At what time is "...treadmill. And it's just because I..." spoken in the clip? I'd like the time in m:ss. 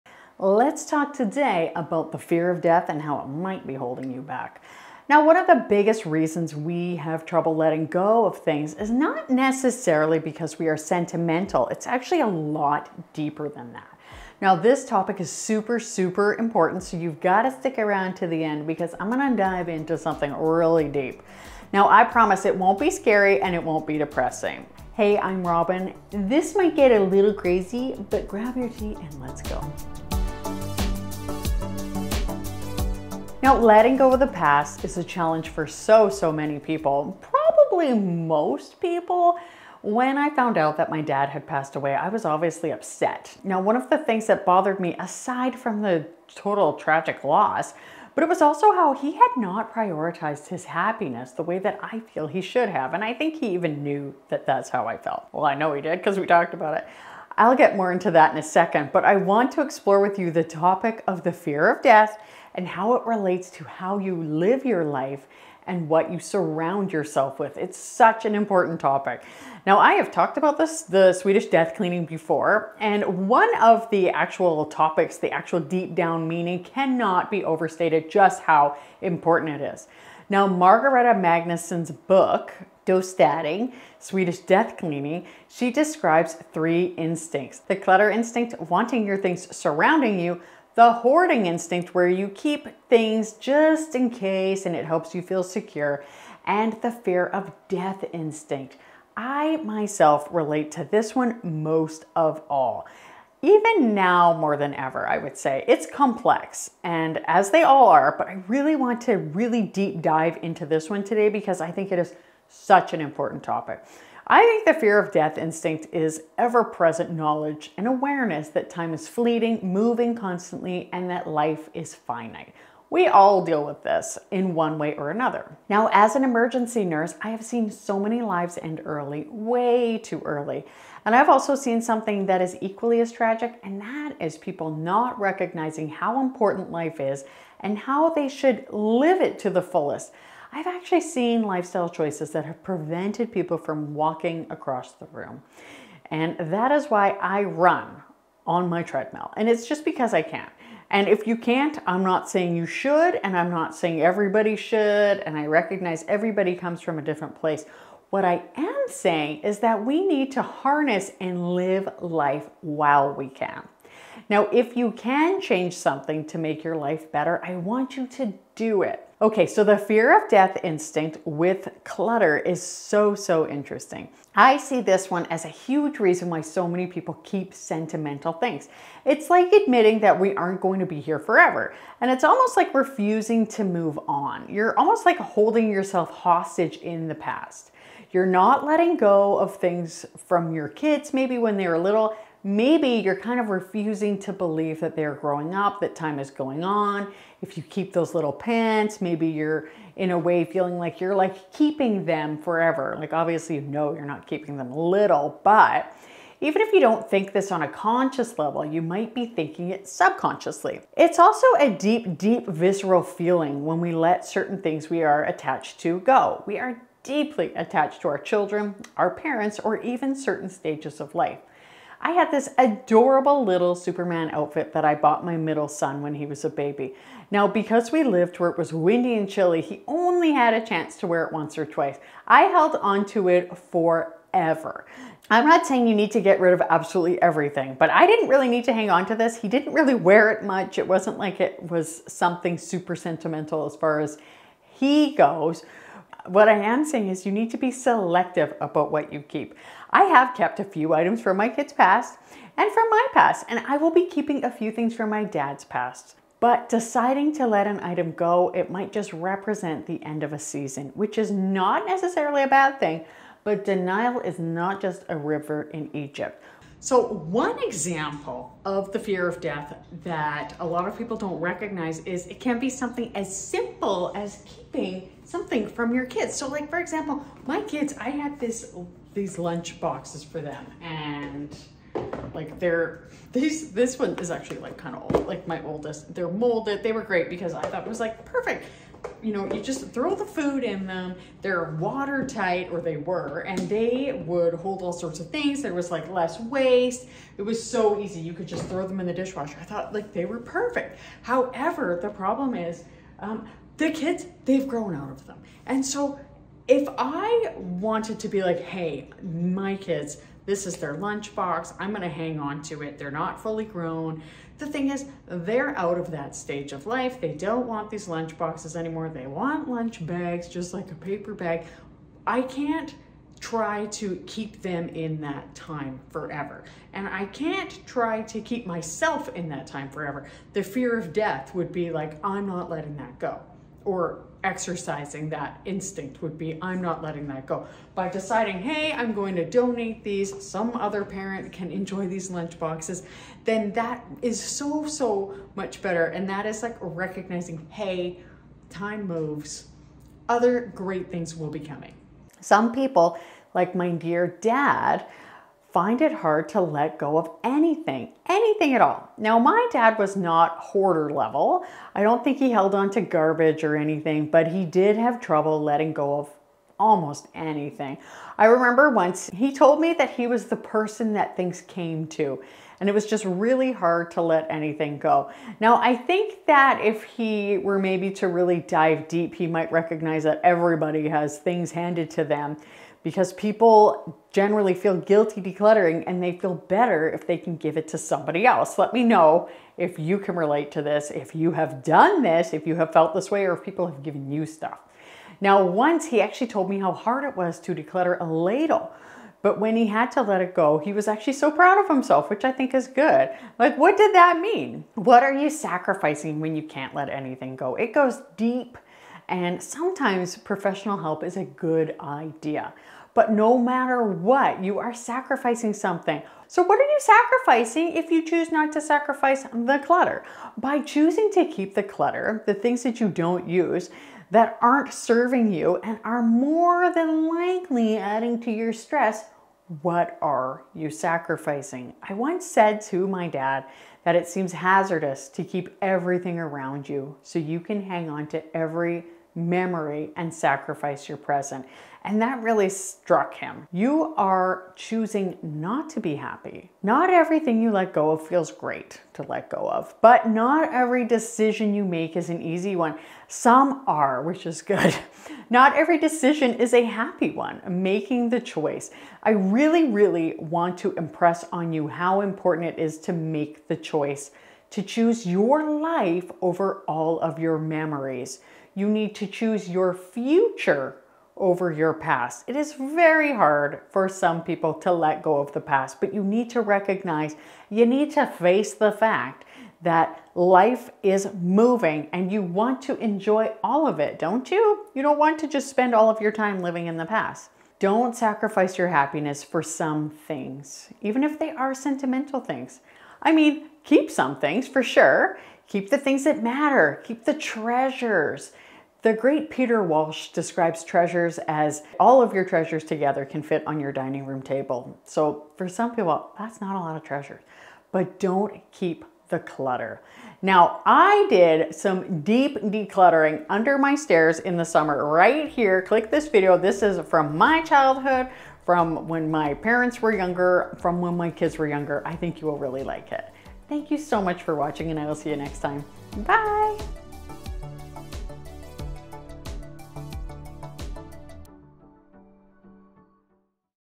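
2:28.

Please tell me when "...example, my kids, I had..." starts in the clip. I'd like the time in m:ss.
4:36.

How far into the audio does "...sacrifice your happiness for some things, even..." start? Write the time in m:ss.
8:08.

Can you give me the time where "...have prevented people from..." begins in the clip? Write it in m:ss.
2:22.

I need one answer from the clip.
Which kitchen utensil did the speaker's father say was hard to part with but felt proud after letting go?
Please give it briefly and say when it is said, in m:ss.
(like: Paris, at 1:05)
A ladle, at 6:38.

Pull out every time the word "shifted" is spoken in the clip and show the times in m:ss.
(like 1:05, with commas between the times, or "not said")
not said.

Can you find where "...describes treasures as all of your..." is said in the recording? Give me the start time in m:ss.
8:20.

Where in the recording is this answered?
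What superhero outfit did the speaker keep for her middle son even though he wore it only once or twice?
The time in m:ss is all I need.
3:43.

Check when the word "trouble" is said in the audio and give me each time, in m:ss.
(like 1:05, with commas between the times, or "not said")
0:07, 6:05.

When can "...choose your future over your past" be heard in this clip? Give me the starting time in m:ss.
7:49.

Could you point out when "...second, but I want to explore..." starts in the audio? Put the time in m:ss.
0:58.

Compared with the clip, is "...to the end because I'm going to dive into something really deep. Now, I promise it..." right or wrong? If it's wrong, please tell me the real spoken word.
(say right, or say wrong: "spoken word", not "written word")
right.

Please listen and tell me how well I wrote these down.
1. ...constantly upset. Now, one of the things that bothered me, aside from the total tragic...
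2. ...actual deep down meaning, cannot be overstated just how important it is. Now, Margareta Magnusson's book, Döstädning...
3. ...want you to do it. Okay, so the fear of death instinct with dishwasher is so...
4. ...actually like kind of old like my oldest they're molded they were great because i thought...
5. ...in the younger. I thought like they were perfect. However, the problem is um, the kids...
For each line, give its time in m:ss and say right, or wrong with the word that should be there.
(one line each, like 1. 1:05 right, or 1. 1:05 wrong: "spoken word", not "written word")
1. 0:42 wrong: "obviously", not "constantly"
2. 1:15 right
3. 2:47 wrong: "clutter", not "dishwasher"
4. 4:44 right
5. 4:58 wrong: "dishwasher", not "younger".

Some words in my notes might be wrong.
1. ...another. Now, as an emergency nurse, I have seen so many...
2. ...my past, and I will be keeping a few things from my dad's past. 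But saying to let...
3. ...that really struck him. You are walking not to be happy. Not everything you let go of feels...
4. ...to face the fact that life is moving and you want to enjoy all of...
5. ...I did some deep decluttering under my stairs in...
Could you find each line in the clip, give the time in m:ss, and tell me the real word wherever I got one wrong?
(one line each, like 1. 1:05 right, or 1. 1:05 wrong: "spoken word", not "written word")
1. 2:05 right
2. 4:12 wrong: "deciding", not "saying"
3. 7:22 wrong: "choosing", not "walking"
4. 7:58 right
5. 8:30 right.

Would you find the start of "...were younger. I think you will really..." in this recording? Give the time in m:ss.
8:41.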